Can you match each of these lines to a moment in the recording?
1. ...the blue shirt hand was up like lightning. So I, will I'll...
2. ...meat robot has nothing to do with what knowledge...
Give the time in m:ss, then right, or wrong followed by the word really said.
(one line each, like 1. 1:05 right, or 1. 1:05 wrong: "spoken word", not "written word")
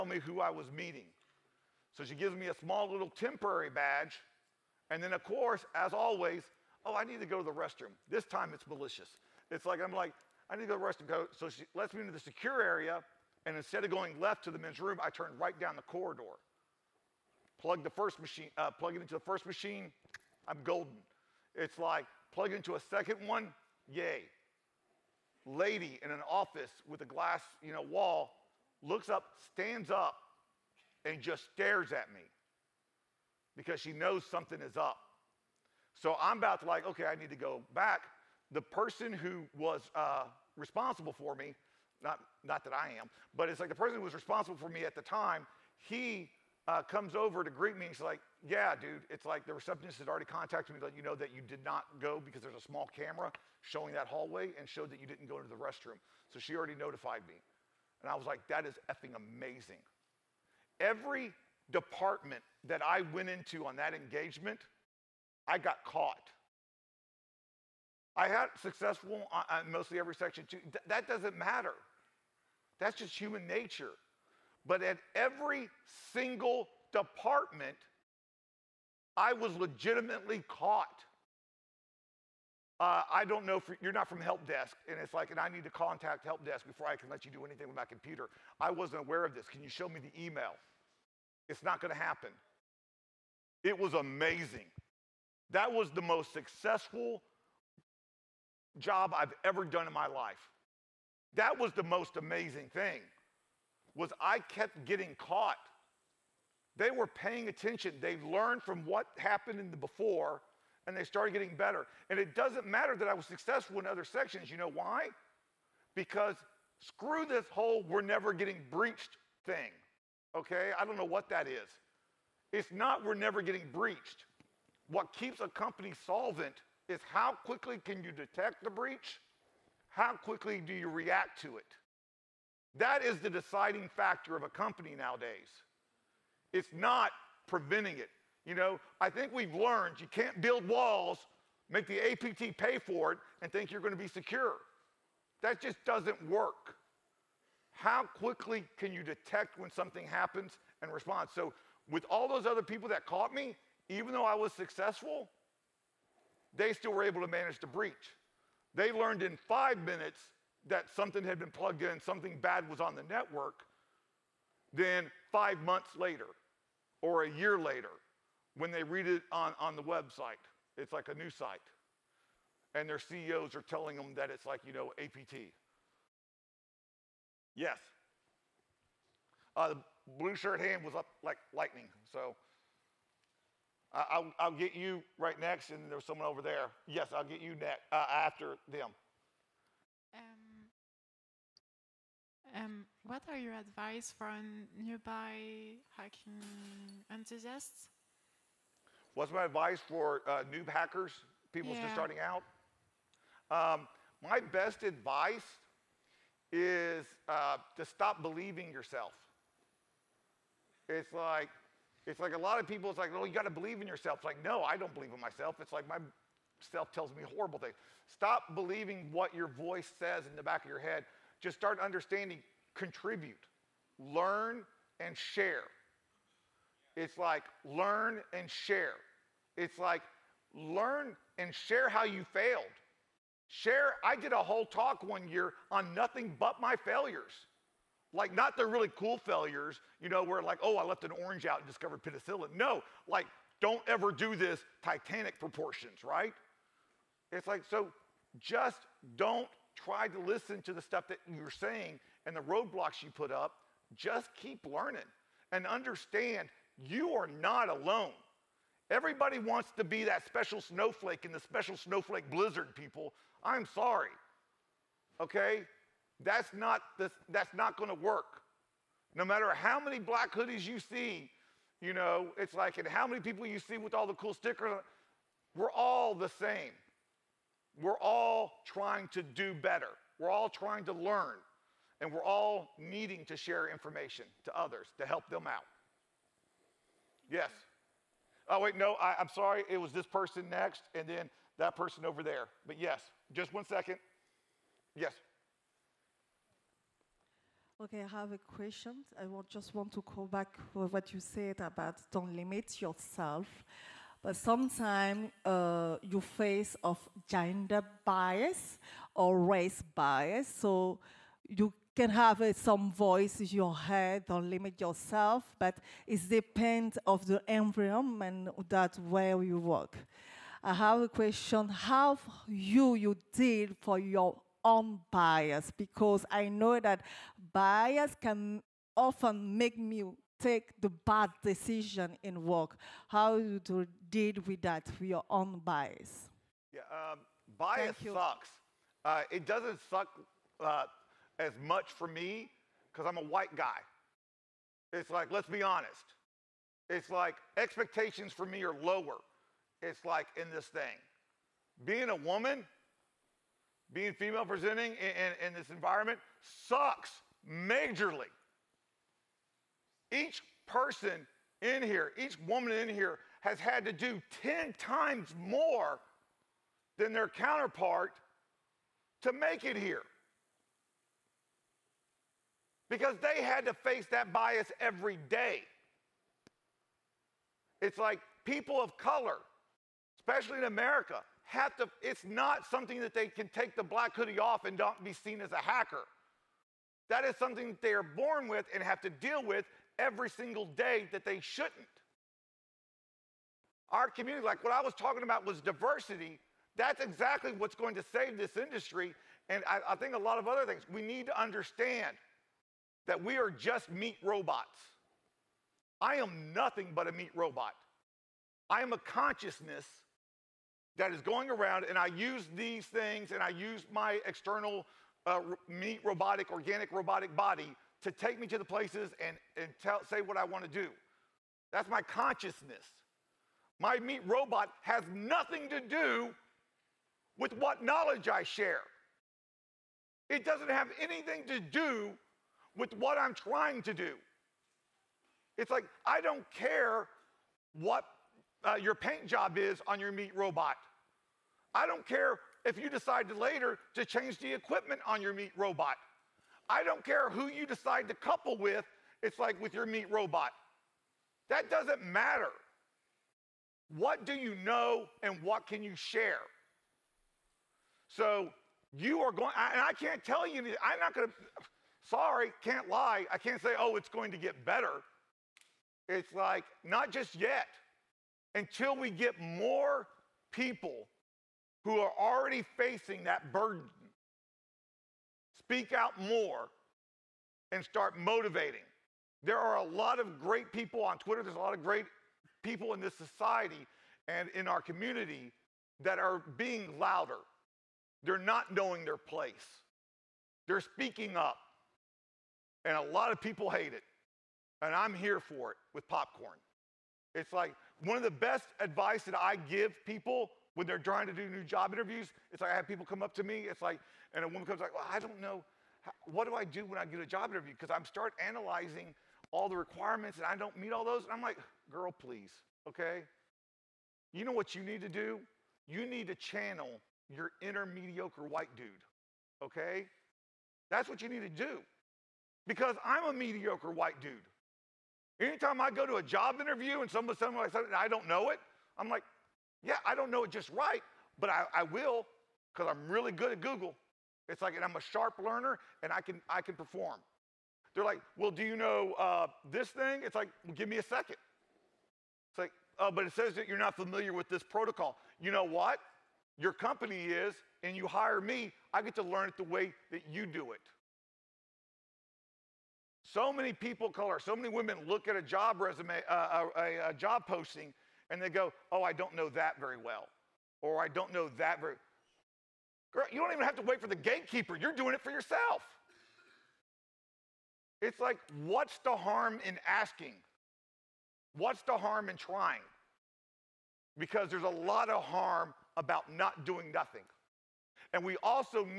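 1. 2:59 right
2. 7:03 right.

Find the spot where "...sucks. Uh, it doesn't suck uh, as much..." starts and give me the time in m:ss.
5:38.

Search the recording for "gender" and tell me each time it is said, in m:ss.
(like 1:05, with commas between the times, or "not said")
5:07.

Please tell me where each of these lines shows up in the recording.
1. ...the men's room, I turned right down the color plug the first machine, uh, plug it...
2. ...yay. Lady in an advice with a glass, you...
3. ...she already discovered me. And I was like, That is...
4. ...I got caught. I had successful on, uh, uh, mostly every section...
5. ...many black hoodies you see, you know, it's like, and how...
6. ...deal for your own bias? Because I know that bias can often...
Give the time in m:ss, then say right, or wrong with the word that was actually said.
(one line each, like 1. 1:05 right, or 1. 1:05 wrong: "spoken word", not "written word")
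1. 0:14 wrong: "corridor", not "color"
2. 0:23 wrong: "office", not "advice"
3. 0:56 wrong: "notified", not "discovered"
4. 1:05 right
5. 4:29 right
6. 5:23 right.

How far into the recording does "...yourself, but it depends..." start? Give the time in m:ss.
5:14.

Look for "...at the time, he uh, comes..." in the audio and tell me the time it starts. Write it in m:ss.
0:44.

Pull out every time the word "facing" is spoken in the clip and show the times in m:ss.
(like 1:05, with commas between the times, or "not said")
7:52.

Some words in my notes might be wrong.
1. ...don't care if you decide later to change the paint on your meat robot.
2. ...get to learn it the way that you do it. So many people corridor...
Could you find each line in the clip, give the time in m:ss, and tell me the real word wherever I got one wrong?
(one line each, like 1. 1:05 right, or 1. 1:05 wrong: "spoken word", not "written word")
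1. 7:21 wrong: "equipment", not "paint"
2. 9:09 wrong: "color", not "corridor".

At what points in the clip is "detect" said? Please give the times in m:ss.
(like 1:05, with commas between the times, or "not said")
2:08, 2:29.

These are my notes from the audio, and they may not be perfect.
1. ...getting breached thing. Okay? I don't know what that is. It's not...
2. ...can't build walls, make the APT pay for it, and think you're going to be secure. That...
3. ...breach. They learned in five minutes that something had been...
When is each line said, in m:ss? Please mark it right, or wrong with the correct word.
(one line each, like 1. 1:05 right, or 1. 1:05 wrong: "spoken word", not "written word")
1. 1:58 right
2. 2:20 right
3. 2:37 right.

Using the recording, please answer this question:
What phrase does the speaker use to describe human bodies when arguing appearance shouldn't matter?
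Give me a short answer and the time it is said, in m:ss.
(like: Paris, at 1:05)
Meat robots, at 6:43.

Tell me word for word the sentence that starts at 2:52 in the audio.
And their CEOs are telling them that it's like, you know, APT.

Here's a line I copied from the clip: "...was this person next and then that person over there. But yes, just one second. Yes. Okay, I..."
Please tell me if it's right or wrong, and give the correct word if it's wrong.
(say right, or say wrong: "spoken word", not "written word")
right.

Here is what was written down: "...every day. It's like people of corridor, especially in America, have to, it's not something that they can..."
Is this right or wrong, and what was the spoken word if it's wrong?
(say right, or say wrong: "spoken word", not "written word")
wrong: "color", not "corridor".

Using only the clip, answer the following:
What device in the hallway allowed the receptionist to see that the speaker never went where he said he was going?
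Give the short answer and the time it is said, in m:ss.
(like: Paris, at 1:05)
Small camera, at 0:52.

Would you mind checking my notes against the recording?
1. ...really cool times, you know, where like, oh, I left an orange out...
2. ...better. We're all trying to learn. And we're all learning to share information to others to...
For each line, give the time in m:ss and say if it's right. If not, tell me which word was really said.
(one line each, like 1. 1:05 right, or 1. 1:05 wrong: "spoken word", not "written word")
1. 3:58 wrong: "failures", not "times"
2. 4:39 wrong: "needing", not "learning".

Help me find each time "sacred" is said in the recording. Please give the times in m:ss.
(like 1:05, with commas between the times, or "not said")
not said.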